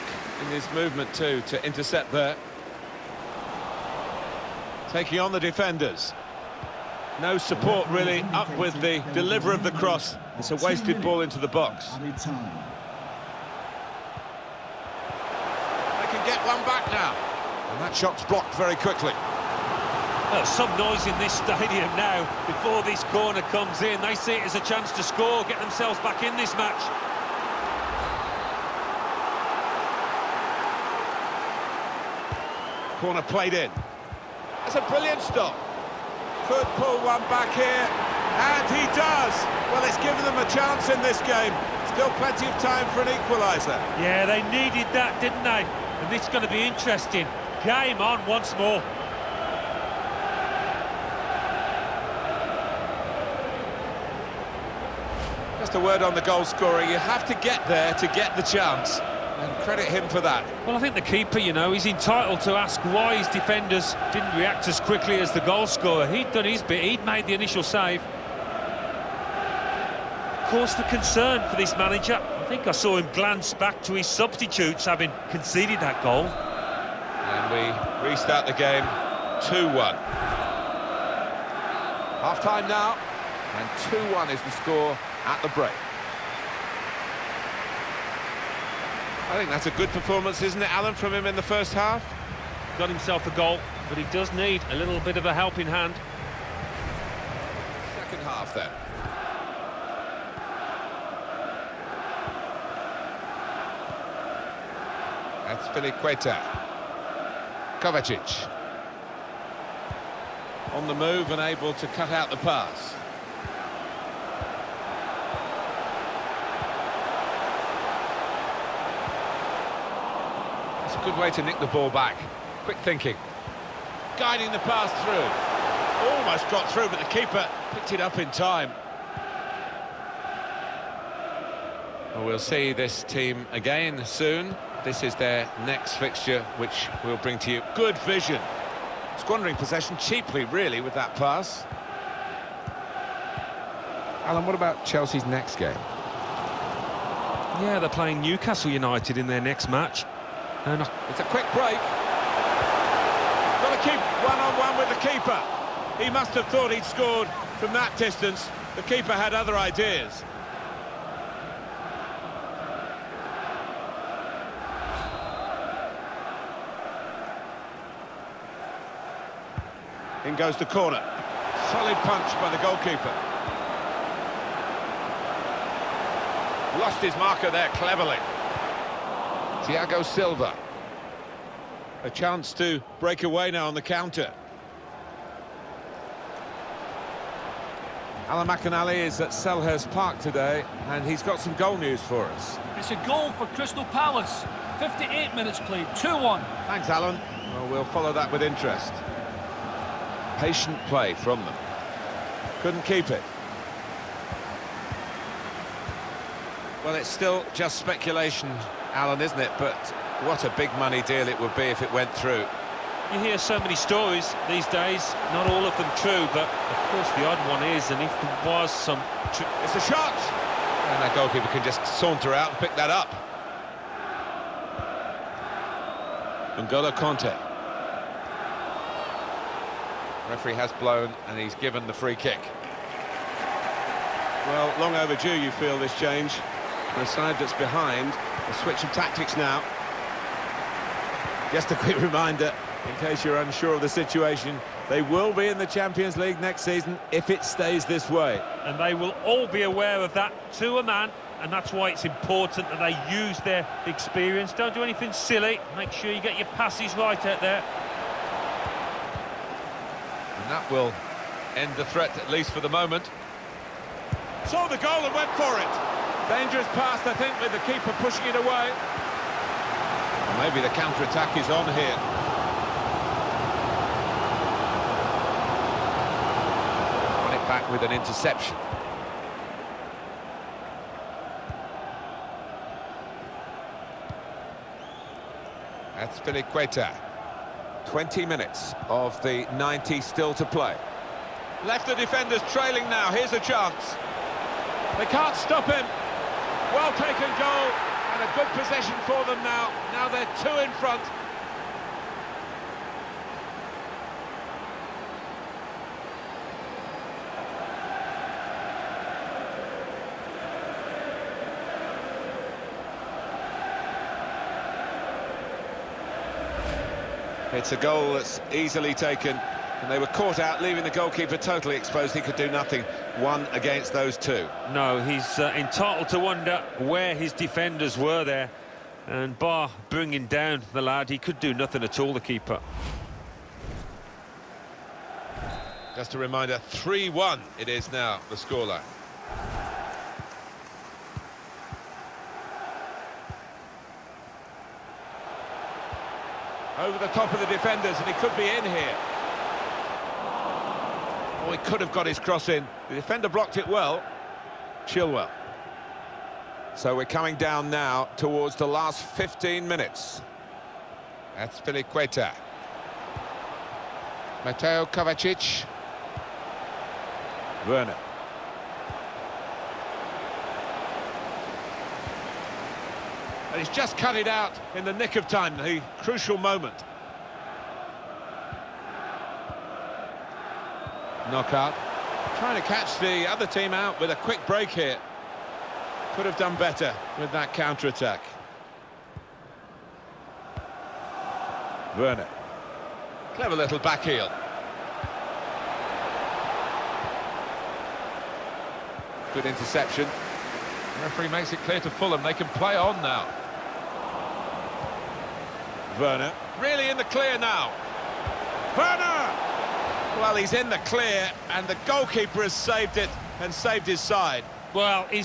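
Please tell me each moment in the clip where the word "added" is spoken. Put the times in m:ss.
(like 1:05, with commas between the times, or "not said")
not said.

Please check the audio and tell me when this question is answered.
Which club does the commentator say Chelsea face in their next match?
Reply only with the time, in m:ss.
2:28.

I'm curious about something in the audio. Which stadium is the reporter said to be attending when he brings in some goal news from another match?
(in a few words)
Selhurst Park.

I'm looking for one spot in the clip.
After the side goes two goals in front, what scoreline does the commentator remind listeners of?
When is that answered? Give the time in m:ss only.
5:36.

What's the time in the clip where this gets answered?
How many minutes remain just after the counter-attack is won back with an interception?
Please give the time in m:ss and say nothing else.
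4:47.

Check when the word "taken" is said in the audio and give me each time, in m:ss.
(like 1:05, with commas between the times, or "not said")
4:56, 5:18.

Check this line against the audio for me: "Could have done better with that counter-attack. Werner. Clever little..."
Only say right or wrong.
right.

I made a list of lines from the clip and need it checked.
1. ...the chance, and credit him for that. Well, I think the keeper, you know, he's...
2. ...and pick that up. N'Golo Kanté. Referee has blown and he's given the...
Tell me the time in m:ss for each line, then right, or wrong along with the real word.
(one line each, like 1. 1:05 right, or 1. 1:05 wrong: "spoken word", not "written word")
1. 0:58 right
2. 3:42 right.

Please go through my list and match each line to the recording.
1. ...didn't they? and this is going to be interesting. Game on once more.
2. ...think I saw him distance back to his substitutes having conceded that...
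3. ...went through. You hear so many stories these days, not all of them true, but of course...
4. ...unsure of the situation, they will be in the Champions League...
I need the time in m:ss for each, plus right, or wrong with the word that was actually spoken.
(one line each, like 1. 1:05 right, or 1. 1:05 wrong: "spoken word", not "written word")
1. 0:45 right
2. 1:12 wrong: "glance", not "distance"
3. 3:31 right
4. 4:03 right.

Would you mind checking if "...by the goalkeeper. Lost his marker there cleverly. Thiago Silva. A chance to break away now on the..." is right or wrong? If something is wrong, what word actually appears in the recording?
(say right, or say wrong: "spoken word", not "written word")
right.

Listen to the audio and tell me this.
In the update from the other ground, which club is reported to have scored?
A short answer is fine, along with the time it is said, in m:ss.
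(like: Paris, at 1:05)
Crystal Palace, at 3:13.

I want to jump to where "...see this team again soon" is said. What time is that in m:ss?
2:12.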